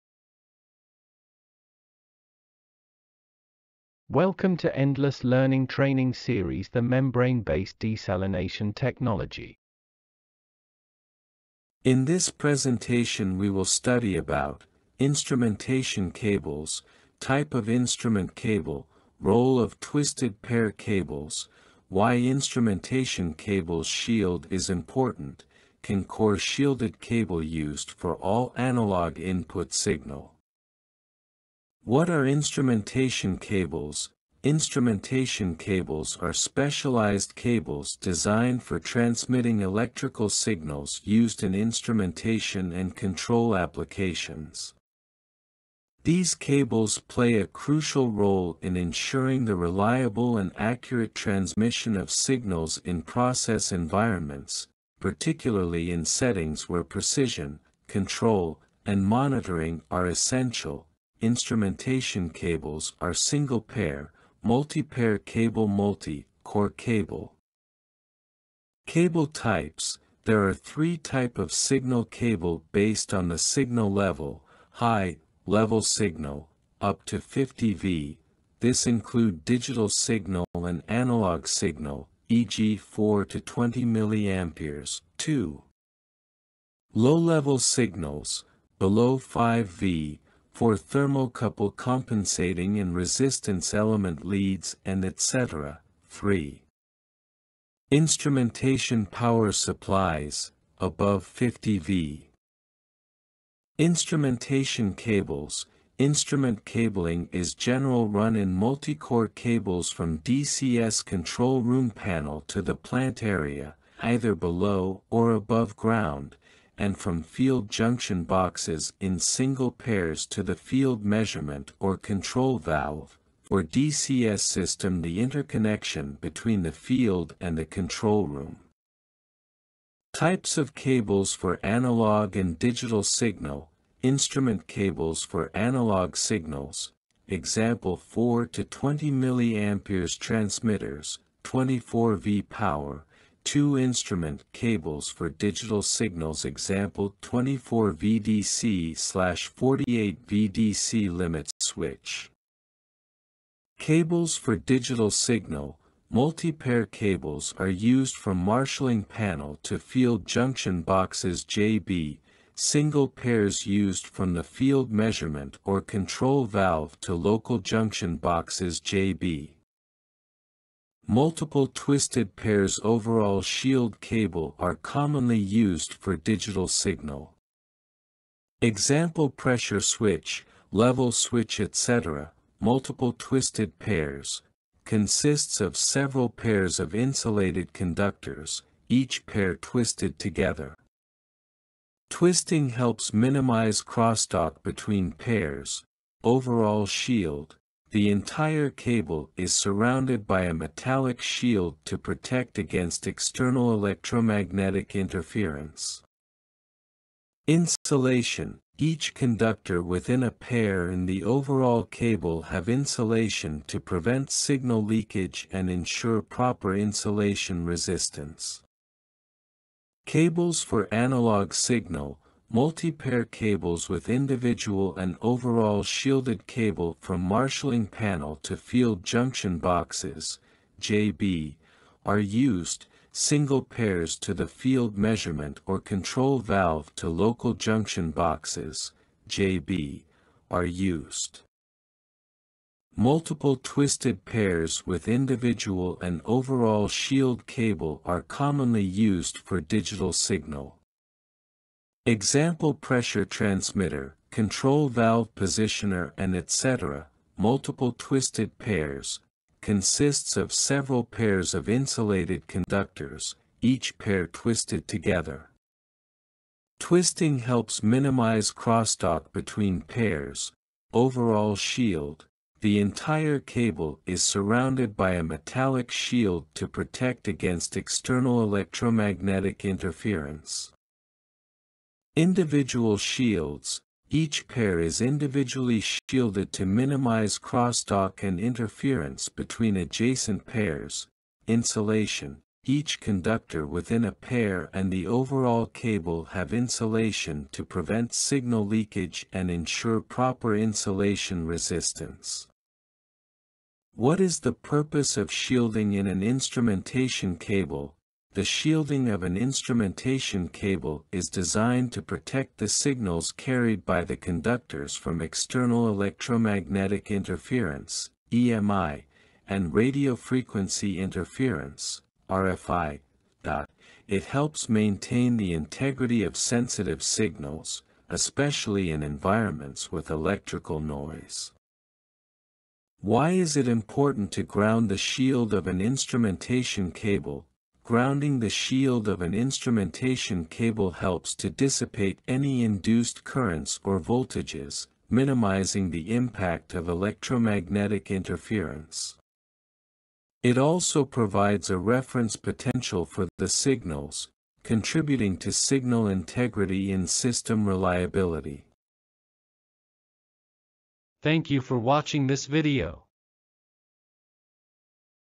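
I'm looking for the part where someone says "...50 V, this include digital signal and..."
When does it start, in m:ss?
1:17.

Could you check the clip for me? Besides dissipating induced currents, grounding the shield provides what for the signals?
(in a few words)
a reference potential.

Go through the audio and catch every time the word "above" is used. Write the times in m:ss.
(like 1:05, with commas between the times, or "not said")
1:40, 1:55.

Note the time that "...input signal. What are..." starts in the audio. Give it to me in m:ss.
0:29.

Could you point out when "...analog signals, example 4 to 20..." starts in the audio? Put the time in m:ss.
2:15.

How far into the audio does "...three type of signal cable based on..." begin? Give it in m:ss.
1:10.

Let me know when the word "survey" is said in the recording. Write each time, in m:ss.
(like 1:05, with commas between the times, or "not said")
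not said.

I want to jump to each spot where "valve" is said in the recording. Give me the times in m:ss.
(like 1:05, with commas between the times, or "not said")
2:02, 2:46, 3:56, 4:14.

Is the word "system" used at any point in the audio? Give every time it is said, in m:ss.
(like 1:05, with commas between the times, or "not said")
2:04, 5:57.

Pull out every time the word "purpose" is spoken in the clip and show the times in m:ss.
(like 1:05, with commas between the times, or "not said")
5:04.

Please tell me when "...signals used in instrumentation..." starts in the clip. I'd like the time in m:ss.
0:40.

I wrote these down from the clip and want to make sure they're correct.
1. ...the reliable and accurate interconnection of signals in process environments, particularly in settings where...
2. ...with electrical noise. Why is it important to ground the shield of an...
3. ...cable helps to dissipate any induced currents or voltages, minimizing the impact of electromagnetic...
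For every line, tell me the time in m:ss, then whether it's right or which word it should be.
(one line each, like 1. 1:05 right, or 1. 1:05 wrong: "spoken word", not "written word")
1. 0:49 wrong: "transmission", not "interconnection"
2. 5:29 right
3. 5:40 right.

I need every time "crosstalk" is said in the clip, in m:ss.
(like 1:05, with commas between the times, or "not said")
3:13, 4:28, 4:47.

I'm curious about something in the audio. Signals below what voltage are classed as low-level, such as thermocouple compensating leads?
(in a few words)
5 V.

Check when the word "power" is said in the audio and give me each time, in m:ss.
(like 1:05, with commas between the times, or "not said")
1:39, 2:22.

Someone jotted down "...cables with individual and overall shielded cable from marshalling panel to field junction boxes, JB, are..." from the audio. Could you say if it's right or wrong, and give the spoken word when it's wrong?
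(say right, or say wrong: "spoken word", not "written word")
right.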